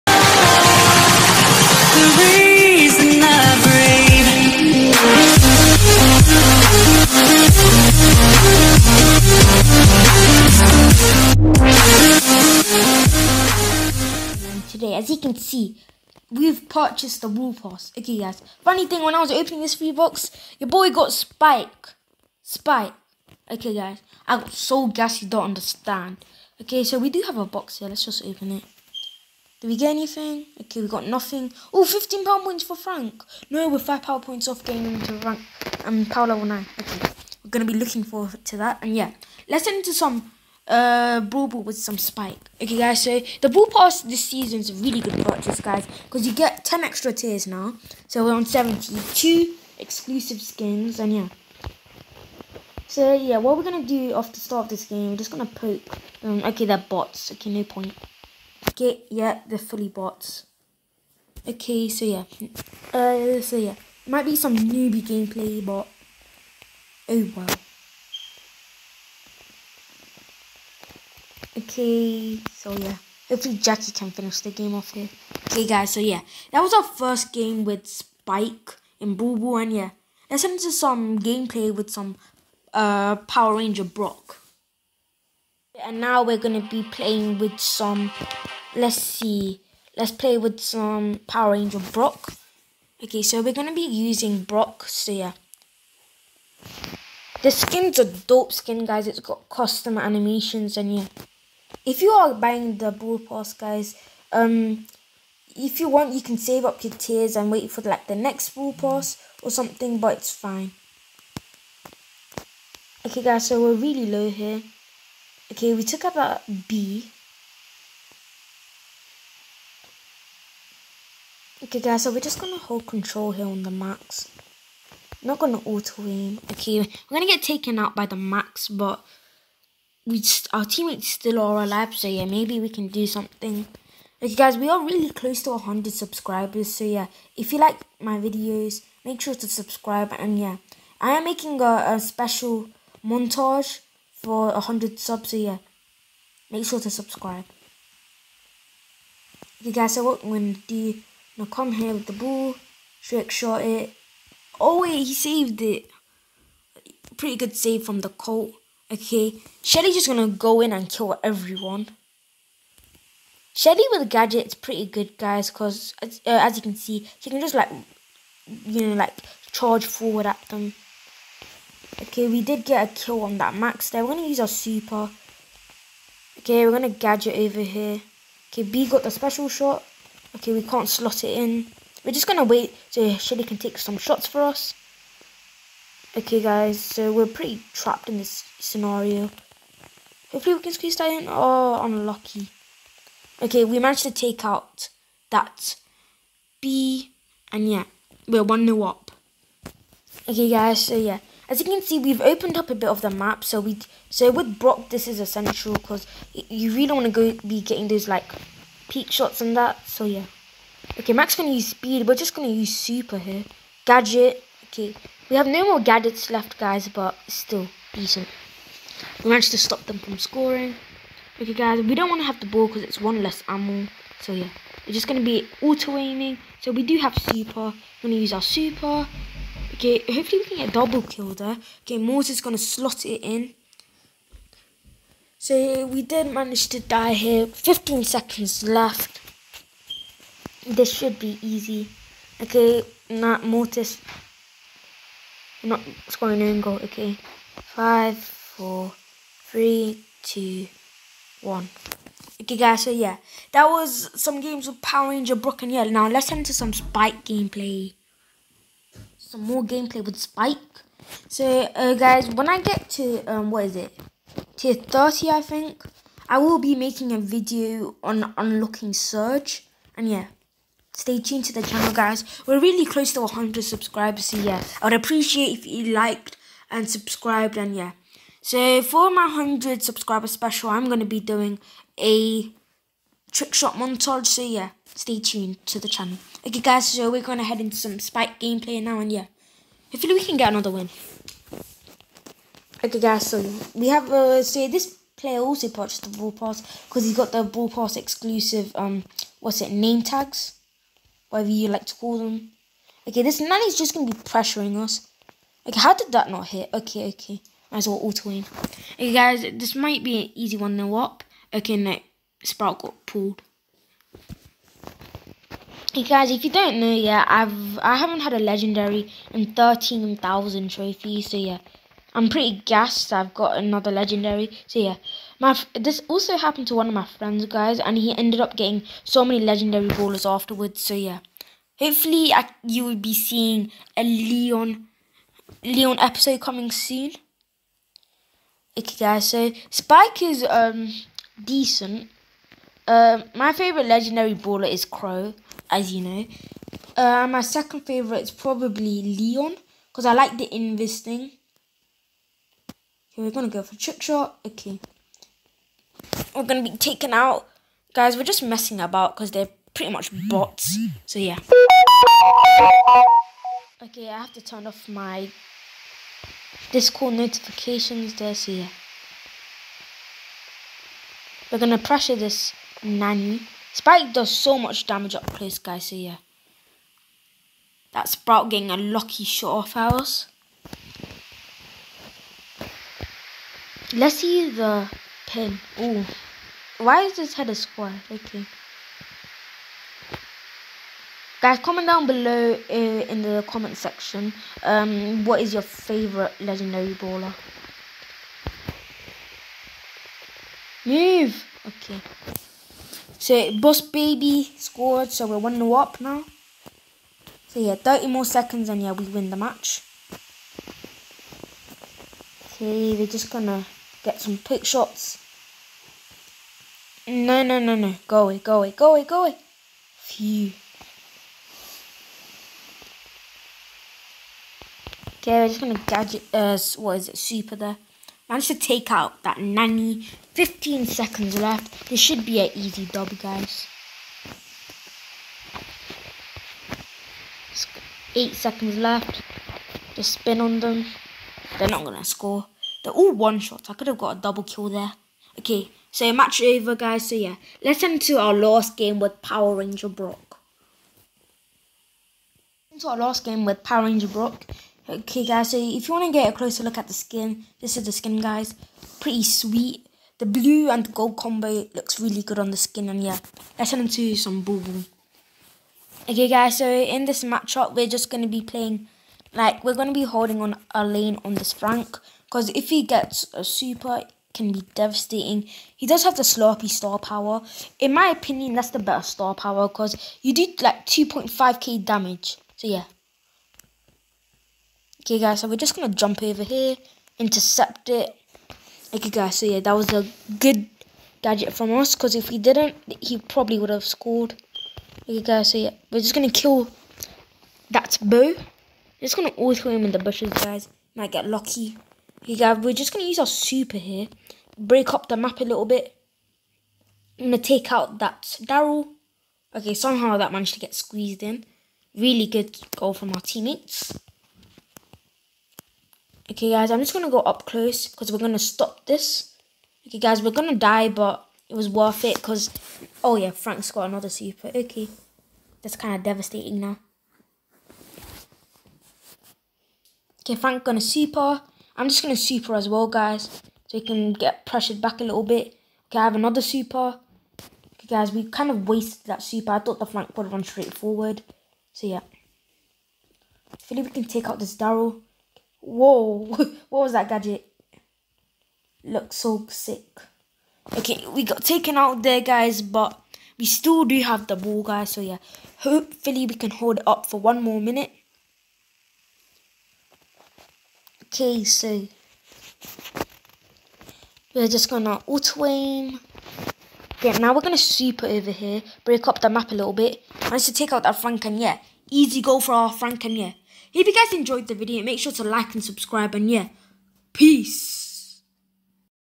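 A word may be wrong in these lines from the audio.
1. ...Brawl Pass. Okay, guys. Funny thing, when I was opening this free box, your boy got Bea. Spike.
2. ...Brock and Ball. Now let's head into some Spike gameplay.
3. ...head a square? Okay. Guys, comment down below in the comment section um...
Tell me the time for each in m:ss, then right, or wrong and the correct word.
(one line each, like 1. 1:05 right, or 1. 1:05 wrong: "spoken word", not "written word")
1. 0:17 wrong: "Spike", not "Bea"
2. 4:15 wrong: "Yell", not "Ball"
3. 6:27 right.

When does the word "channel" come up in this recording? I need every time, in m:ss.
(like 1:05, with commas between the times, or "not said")
4:31, 4:45.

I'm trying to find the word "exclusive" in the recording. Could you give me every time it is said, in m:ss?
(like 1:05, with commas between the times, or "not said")
0:49, 4:57.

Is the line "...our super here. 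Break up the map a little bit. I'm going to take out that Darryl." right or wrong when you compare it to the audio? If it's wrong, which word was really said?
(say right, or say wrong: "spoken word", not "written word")
right.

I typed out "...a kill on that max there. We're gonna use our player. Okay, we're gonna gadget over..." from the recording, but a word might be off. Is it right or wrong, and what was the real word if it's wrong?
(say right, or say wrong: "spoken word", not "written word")
wrong: "super", not "player".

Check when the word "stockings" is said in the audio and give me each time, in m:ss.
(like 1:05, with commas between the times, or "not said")
not said.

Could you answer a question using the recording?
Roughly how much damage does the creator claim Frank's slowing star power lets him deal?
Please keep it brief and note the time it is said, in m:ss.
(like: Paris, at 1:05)
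2.5k, at 8:00.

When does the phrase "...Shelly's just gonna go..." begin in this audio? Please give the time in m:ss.
2:39.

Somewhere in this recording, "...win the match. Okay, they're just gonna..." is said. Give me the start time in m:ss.
6:49.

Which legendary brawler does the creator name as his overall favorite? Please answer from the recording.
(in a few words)
Crow.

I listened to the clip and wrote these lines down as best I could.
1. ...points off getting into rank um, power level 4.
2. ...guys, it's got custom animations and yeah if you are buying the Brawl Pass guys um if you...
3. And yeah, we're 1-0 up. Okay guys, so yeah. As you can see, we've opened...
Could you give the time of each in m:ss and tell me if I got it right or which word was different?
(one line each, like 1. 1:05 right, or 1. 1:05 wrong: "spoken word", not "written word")
1. 0:34 wrong: "9", not "4"
2. 1:38 right
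3. 3:17 right.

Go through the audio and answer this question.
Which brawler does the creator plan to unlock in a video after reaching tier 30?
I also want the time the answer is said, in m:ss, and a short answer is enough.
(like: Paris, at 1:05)
Surge, at 4:28.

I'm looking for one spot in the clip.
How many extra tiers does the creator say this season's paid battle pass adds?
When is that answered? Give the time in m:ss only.
0:46.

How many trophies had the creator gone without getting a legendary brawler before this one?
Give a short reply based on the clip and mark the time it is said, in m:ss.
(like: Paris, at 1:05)
13000, at 5:19.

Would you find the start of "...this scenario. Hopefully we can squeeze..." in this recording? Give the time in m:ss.
3:08.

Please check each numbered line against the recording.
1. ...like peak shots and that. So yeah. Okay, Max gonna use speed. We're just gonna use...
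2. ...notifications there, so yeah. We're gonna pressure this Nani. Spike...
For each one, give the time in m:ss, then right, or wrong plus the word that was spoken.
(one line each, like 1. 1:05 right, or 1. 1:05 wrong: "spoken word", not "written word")
1. 3:28 right
2. 6:07 right.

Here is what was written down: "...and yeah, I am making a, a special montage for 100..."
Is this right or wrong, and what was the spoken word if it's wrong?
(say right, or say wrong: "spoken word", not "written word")
right.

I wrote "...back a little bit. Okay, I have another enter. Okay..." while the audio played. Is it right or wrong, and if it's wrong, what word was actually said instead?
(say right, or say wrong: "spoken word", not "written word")
wrong: "super", not "enter".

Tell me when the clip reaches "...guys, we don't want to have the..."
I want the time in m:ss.
3:41.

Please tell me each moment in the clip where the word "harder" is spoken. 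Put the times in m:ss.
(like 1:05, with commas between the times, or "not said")
not said.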